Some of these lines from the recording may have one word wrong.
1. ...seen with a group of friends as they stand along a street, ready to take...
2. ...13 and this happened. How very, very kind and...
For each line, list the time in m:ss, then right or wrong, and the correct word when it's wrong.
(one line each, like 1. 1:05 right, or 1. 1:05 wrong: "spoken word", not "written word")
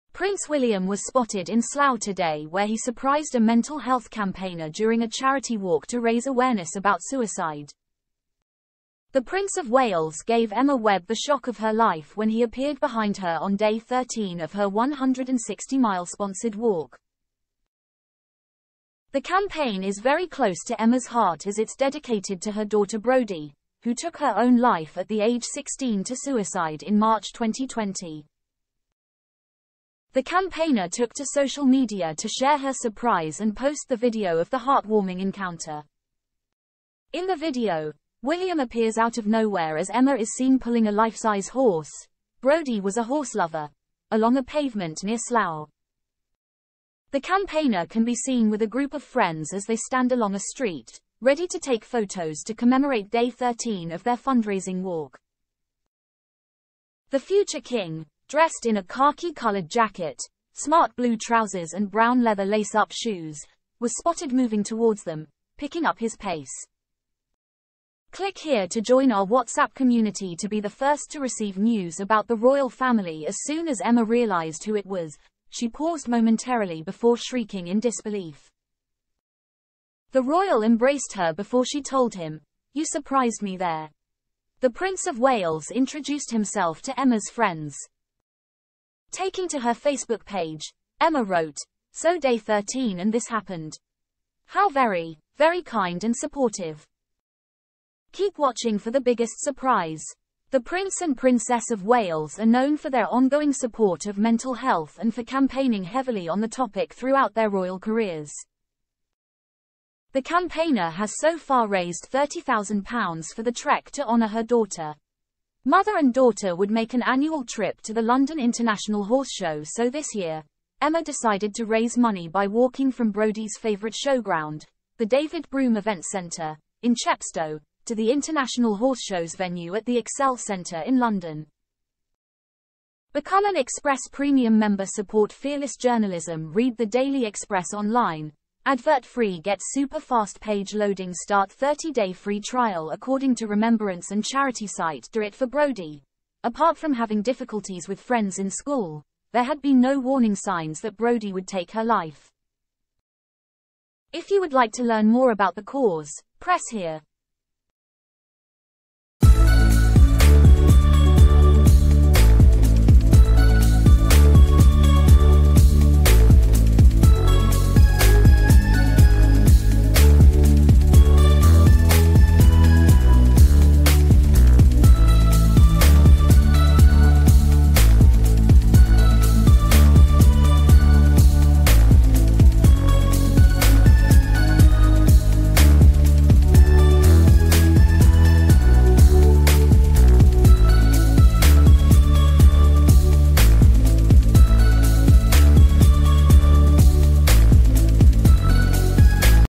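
1. 0:48 right
2. 1:32 right.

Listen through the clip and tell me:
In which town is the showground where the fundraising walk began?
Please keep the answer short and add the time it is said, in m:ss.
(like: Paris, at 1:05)
Chepstow, at 2:06.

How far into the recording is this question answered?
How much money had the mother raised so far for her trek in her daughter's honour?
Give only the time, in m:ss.
1:52.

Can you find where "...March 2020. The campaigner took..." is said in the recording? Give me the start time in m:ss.
0:26.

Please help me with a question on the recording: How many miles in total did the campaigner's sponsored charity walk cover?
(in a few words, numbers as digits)
160 miles.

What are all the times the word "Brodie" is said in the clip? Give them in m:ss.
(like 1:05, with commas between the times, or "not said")
0:22, 0:42, 2:03, 2:25, 2:30.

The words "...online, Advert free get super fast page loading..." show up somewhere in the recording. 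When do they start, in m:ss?
2:17.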